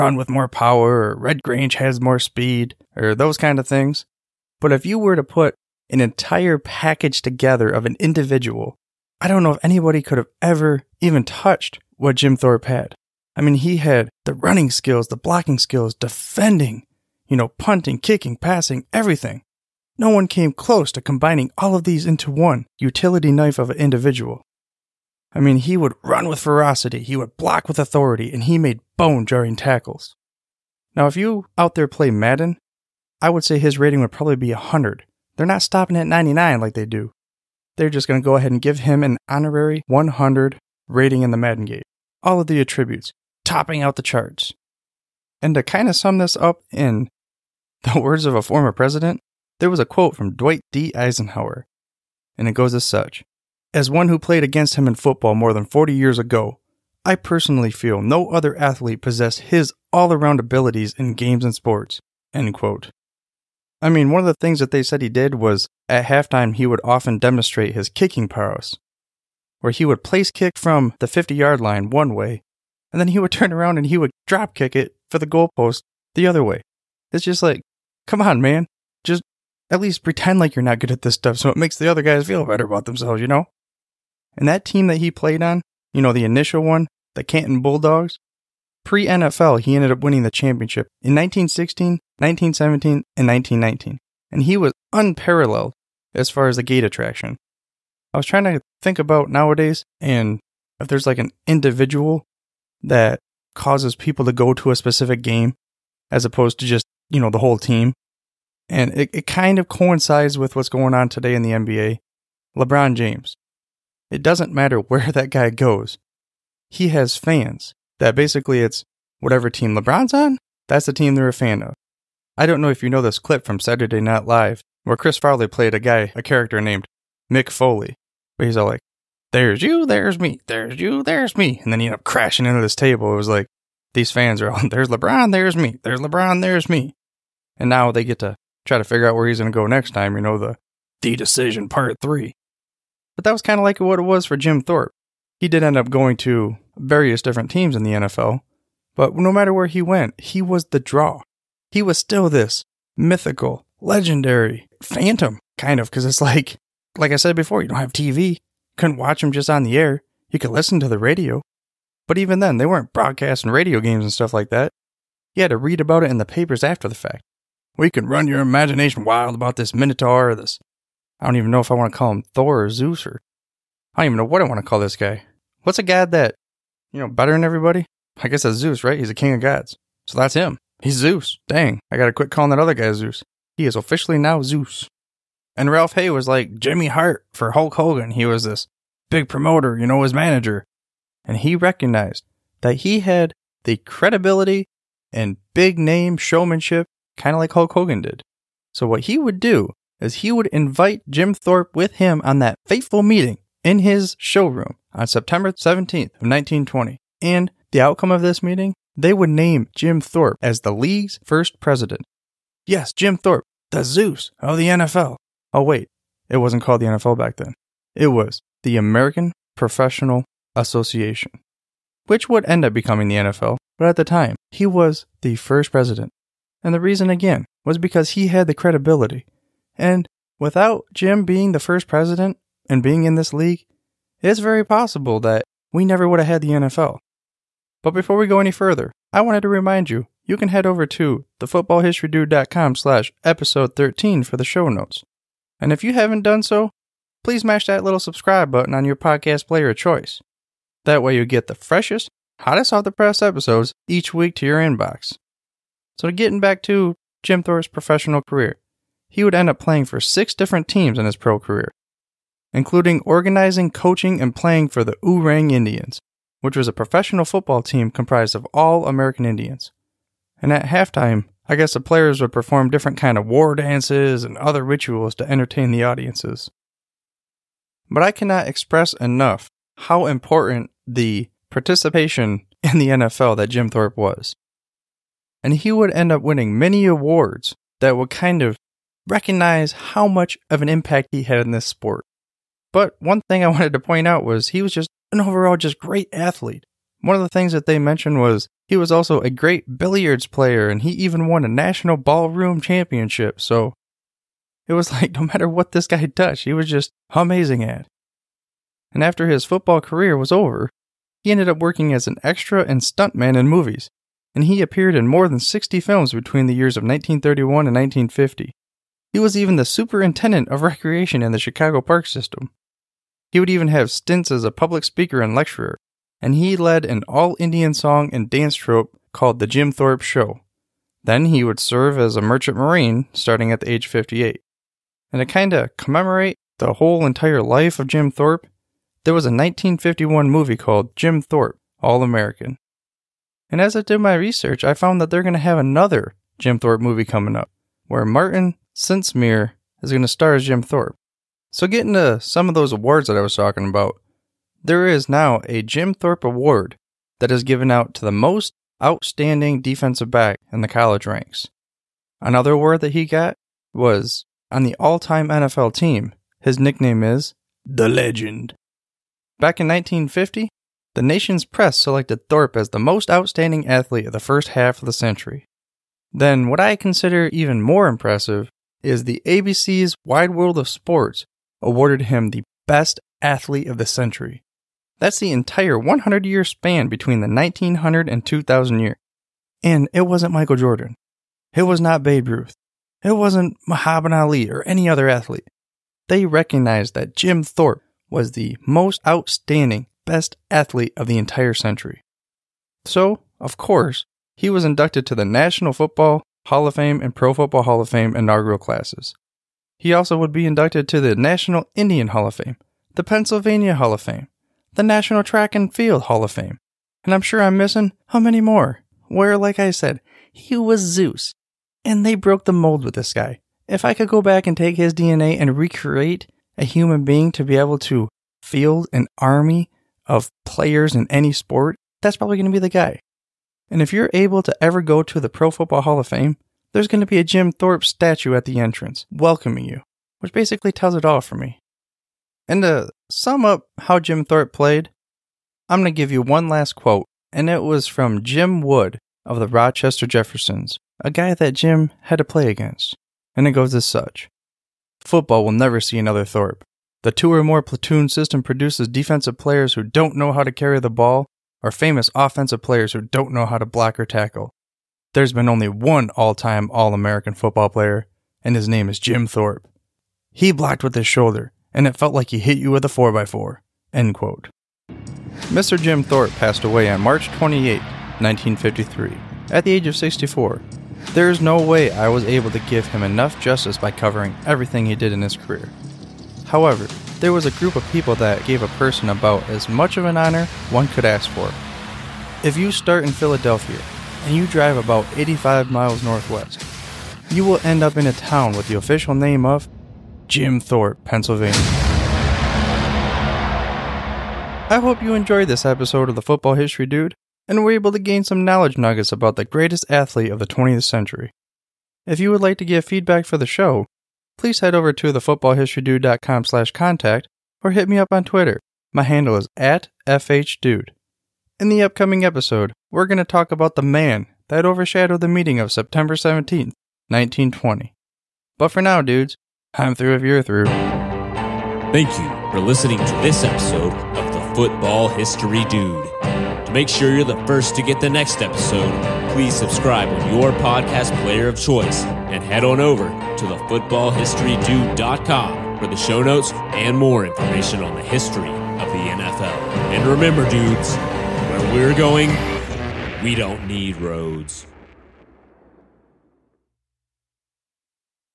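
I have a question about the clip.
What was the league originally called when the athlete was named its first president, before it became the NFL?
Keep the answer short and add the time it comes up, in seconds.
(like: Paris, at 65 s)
American Professional Association, at 218 s.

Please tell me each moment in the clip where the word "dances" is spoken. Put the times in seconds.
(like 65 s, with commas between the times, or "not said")
273 s, 328 s.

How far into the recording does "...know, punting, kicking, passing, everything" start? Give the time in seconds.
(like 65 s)
17 s.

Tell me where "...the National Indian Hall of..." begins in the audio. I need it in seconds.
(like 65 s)
411 s.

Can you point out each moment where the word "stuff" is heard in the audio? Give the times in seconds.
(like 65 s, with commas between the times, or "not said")
81 s, 164 s.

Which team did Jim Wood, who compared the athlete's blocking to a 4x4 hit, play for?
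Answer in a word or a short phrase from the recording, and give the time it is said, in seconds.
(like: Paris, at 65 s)
Rochester Jeffersons, at 449 s.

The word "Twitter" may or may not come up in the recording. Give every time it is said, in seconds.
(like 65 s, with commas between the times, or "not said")
518 s.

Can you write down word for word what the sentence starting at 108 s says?
And it, it kind of coincides with what's going on today in the NBA.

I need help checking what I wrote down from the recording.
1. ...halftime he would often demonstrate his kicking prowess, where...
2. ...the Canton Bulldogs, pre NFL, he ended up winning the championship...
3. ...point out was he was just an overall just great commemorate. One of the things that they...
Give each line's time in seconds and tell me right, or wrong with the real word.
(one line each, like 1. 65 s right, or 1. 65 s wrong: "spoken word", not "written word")
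1. 66 s right
2. 87 s right
3. 293 s wrong: "athlete", not "commemorate".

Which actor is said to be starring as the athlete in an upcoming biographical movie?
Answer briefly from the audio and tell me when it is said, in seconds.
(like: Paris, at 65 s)
Martin Sensmeier, at 348 s.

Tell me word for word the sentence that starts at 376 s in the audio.
Then, what I consider even more impressive is the ABC's Wide World of Sports awarded him the Best Athlete of the Century.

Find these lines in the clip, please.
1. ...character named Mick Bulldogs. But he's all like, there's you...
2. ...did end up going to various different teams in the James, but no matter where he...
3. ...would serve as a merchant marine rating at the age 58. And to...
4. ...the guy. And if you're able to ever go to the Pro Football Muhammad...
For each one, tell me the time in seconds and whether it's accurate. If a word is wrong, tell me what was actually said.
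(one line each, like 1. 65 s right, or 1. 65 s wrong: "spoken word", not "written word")
1. 126 s wrong: "Foley", not "Bulldogs"
2. 145 s wrong: "NFL", not "James"
3. 331 s wrong: "starting", not "rating"
4. 432 s wrong: "Hall", not "Muhammad".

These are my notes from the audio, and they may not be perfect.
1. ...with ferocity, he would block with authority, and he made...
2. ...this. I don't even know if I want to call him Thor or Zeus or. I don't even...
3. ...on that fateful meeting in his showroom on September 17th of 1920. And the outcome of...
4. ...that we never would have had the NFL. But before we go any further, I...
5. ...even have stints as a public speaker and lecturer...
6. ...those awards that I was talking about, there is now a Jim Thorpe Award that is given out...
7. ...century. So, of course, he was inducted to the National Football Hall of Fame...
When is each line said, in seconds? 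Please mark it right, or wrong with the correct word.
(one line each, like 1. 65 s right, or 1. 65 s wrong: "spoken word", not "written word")
1. 26 s right
2. 170 s right
3. 202 s right
4. 235 s right
5. 323 s right
6. 352 s right
7. 401 s right.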